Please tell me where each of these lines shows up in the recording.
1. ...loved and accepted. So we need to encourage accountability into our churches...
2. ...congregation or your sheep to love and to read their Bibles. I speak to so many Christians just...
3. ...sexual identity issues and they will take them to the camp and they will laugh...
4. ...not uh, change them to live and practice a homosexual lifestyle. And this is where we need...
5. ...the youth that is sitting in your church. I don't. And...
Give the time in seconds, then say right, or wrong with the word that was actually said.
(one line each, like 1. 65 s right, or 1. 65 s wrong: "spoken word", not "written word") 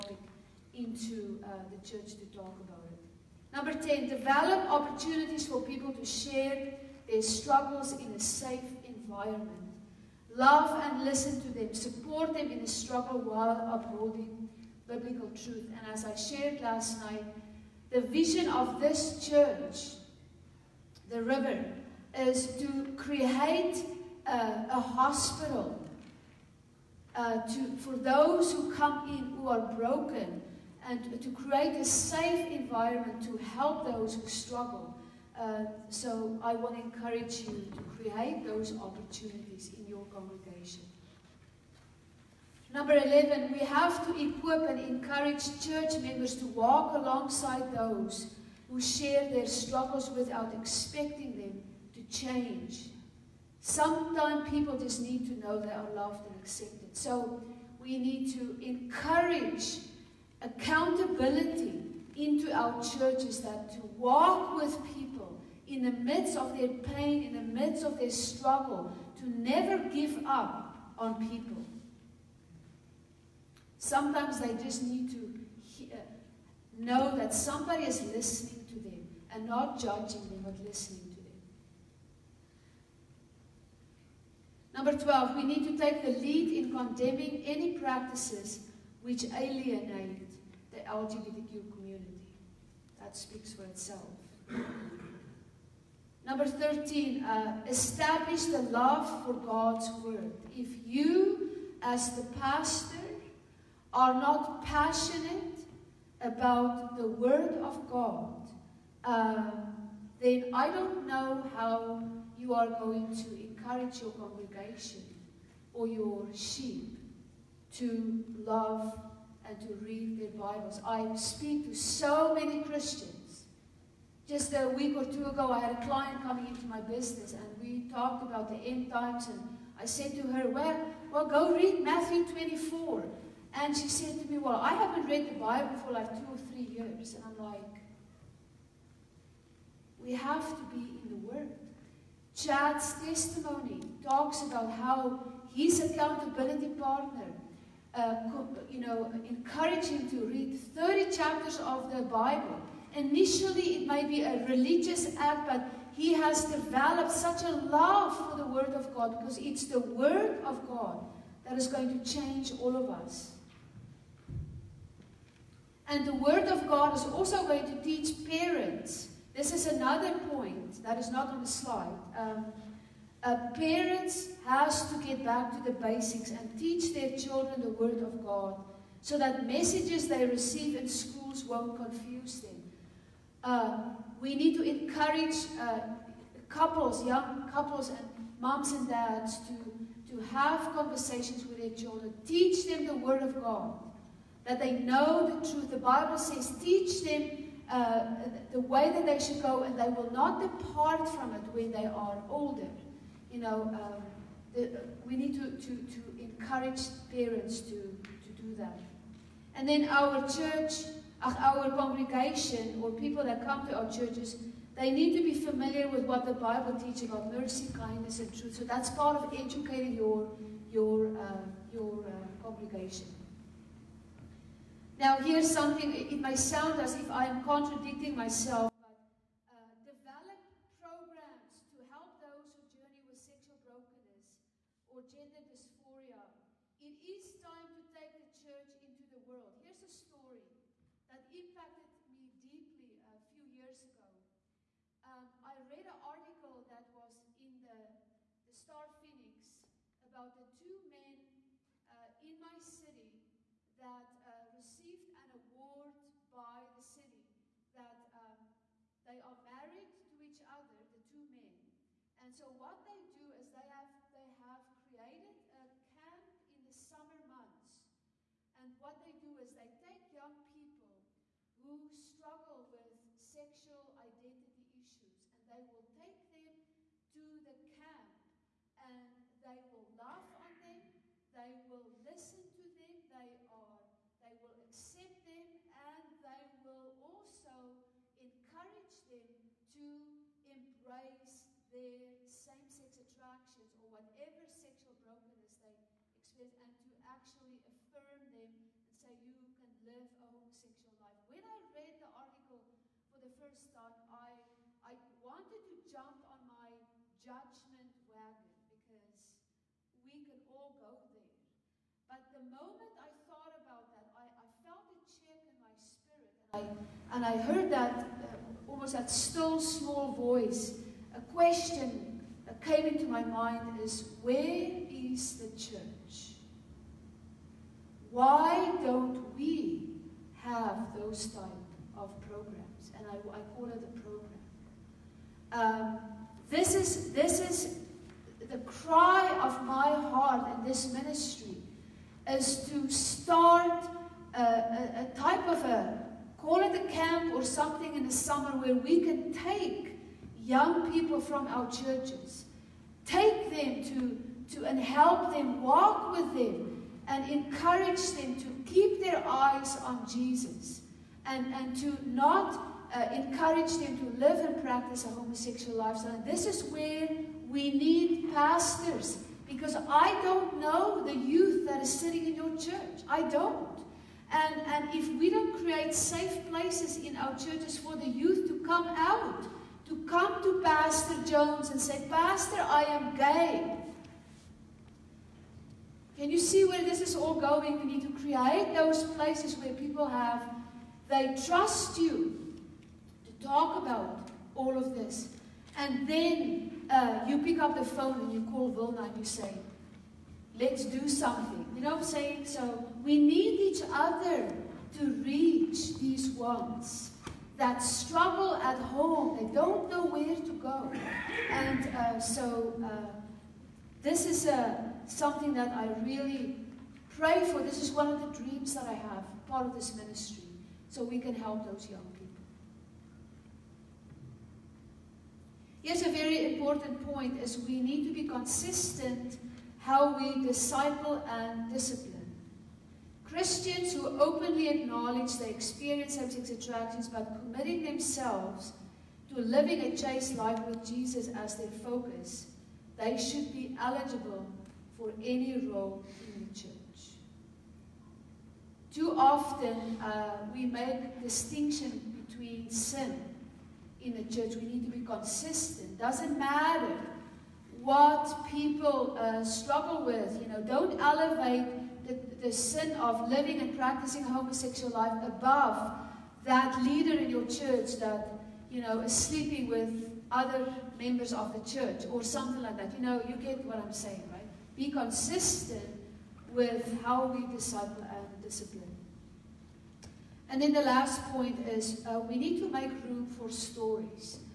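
1. 55 s right
2. 114 s right
3. 273 s right
4. 362 s wrong: "encourage", not "change"
5. 371 s right.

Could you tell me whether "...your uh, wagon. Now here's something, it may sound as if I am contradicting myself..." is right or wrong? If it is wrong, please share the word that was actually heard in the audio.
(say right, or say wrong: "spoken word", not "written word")
wrong: "congregation", not "wagon".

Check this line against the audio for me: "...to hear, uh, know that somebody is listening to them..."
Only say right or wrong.
right.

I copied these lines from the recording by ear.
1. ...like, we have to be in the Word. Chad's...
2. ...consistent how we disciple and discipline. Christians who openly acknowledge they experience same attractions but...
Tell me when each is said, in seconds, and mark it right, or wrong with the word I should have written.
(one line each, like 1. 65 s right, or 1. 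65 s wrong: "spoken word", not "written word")
1. 137 s right
2. 428 s right.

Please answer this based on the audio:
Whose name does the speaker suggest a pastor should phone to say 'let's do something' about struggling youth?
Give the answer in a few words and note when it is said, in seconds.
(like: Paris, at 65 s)
Wilna, at 398 s.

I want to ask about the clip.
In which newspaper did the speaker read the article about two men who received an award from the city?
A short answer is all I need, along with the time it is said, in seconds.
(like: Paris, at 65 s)
Star Phoenix, at 248 s.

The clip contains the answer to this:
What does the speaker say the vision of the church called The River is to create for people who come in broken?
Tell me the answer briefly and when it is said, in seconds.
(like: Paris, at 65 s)
a hospital, at 24 s.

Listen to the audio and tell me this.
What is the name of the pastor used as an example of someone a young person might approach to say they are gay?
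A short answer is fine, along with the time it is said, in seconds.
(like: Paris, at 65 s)
Pastor Jones, at 380 s.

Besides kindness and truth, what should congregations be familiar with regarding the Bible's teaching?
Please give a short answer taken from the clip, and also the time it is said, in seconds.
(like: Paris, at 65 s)
mercy, at 217 s.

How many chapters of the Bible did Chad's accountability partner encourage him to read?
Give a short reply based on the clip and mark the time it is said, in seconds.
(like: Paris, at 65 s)
30, at 150 s.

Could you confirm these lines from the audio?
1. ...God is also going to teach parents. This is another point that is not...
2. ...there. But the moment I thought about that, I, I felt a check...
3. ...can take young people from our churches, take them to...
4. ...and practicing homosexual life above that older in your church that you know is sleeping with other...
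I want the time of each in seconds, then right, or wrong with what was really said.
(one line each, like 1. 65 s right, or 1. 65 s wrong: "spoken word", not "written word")
1. 166 s right
2. 311 s right
3. 349 s right
4. 463 s wrong: "leader", not "older".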